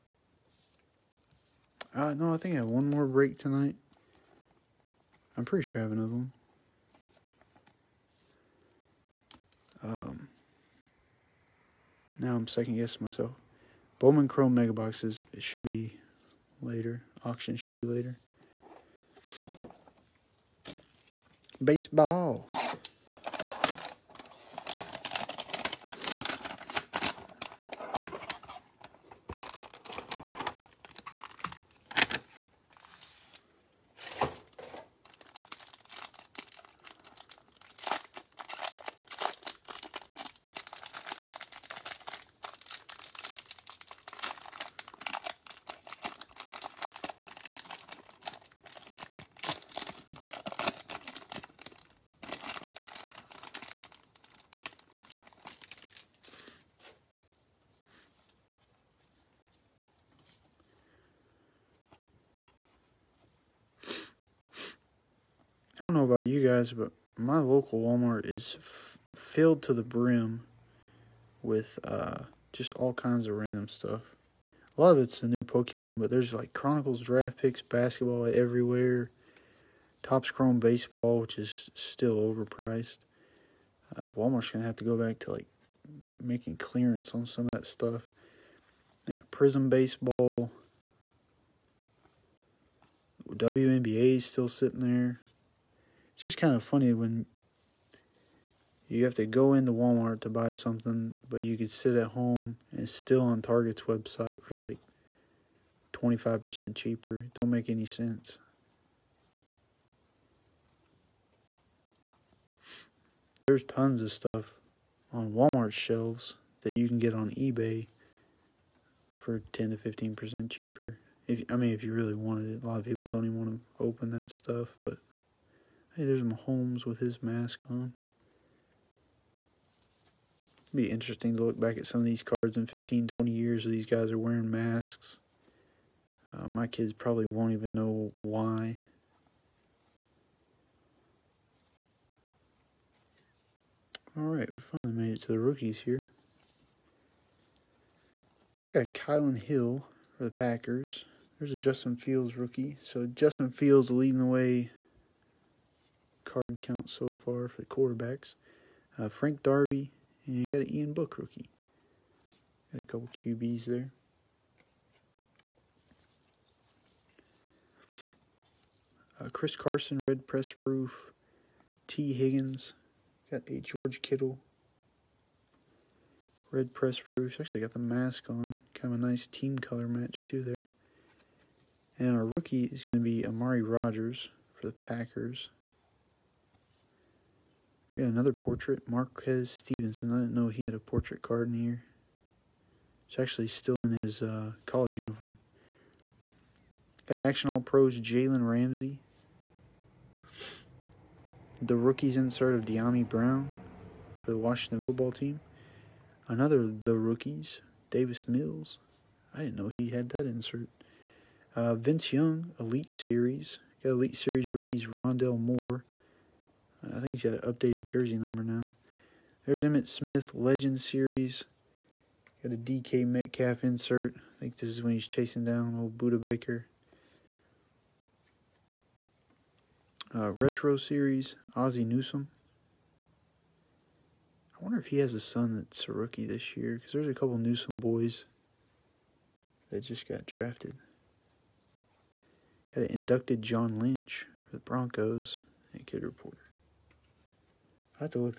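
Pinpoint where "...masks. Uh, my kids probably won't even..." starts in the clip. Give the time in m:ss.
2:14.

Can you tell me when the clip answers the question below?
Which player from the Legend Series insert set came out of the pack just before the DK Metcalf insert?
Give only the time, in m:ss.
3:39.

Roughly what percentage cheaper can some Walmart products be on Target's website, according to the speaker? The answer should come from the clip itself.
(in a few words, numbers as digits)
25%.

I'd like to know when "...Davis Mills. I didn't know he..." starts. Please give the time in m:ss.
3:27.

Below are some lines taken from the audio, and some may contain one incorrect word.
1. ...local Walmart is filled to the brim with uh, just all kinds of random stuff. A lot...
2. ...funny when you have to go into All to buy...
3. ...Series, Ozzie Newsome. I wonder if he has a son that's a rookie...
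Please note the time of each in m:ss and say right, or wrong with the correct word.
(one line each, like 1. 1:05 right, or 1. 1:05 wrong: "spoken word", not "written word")
1. 1:07 right
2. 1:36 wrong: "Walmart", not "All"
3. 3:50 right.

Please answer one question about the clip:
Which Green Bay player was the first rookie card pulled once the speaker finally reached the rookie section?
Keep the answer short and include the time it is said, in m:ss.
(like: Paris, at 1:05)
Kylan Hill, at 2:28.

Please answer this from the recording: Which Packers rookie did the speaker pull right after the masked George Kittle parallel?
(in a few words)
Amari Rogers.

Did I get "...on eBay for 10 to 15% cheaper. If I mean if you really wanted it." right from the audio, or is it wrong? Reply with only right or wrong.
right.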